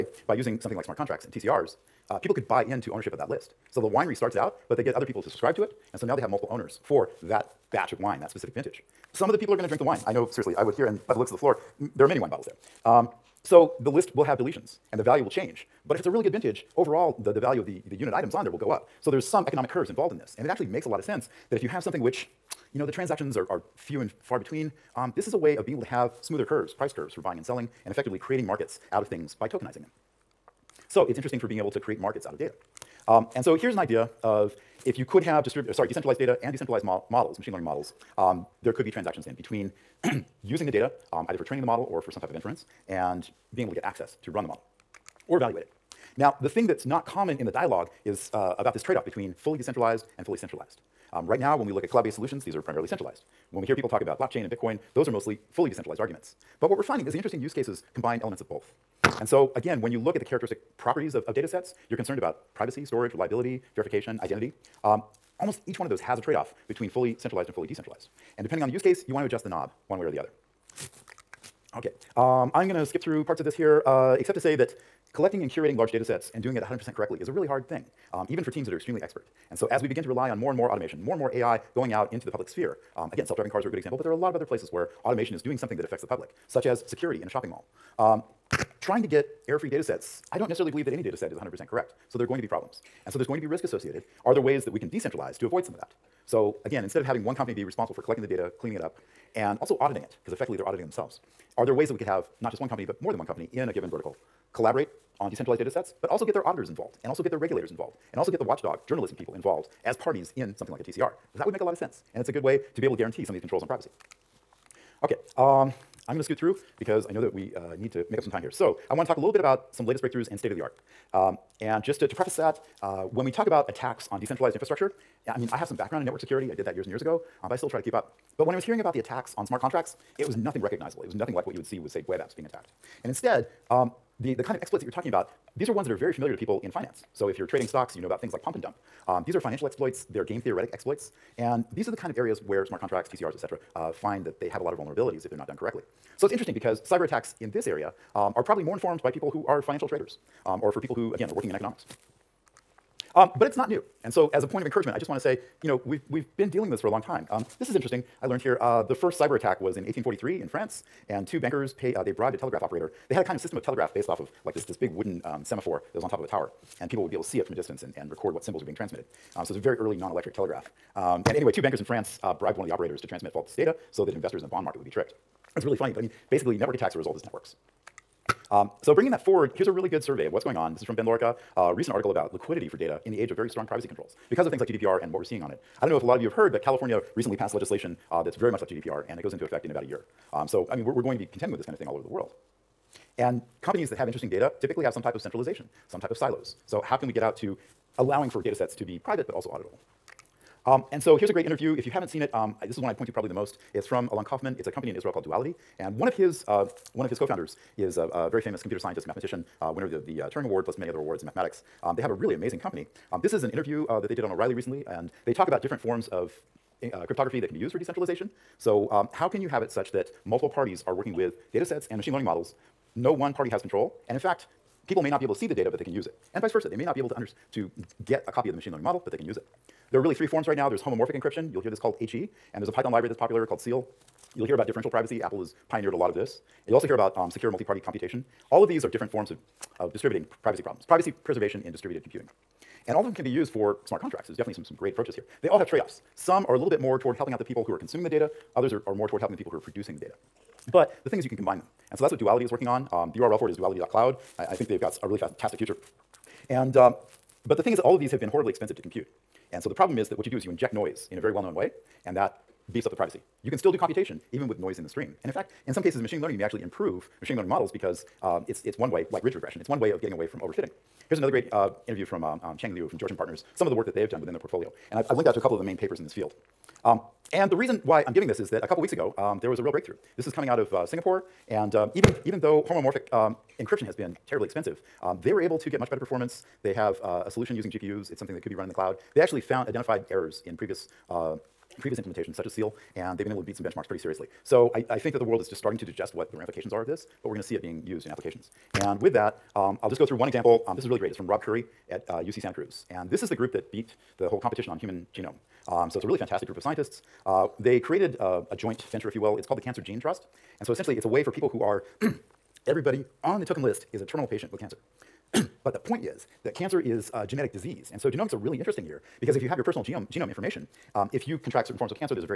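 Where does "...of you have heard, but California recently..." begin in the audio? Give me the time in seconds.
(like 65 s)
186 s.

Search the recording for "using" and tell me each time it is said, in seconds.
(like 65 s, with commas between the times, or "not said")
0 s, 40 s, 287 s.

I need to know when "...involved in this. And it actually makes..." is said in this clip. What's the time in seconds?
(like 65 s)
19 s.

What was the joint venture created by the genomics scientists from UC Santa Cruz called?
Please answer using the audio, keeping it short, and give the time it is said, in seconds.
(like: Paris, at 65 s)
Cancer Gene Trust, at 309 s.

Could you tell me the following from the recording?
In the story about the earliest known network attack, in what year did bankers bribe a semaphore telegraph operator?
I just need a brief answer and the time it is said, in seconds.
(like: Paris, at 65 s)
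1843, at 159 s.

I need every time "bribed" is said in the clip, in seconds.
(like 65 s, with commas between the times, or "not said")
162 s, 172 s.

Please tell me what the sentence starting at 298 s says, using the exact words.
And with that, um, I'll just go through one example.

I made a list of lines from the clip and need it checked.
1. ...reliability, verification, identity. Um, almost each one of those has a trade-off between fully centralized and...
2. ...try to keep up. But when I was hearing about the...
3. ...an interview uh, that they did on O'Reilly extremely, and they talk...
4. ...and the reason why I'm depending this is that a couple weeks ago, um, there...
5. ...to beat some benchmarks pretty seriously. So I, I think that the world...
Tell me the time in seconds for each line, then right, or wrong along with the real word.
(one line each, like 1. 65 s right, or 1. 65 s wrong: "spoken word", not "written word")
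1. 63 s right
2. 127 s right
3. 213 s wrong: "recently", not "extremely"
4. 277 s wrong: "giving", not "depending"
5. 293 s right.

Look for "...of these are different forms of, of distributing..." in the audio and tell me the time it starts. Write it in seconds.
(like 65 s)
238 s.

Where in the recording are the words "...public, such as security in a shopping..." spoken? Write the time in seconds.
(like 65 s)
86 s.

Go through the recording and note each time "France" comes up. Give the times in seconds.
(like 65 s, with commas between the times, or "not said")
160 s, 171 s.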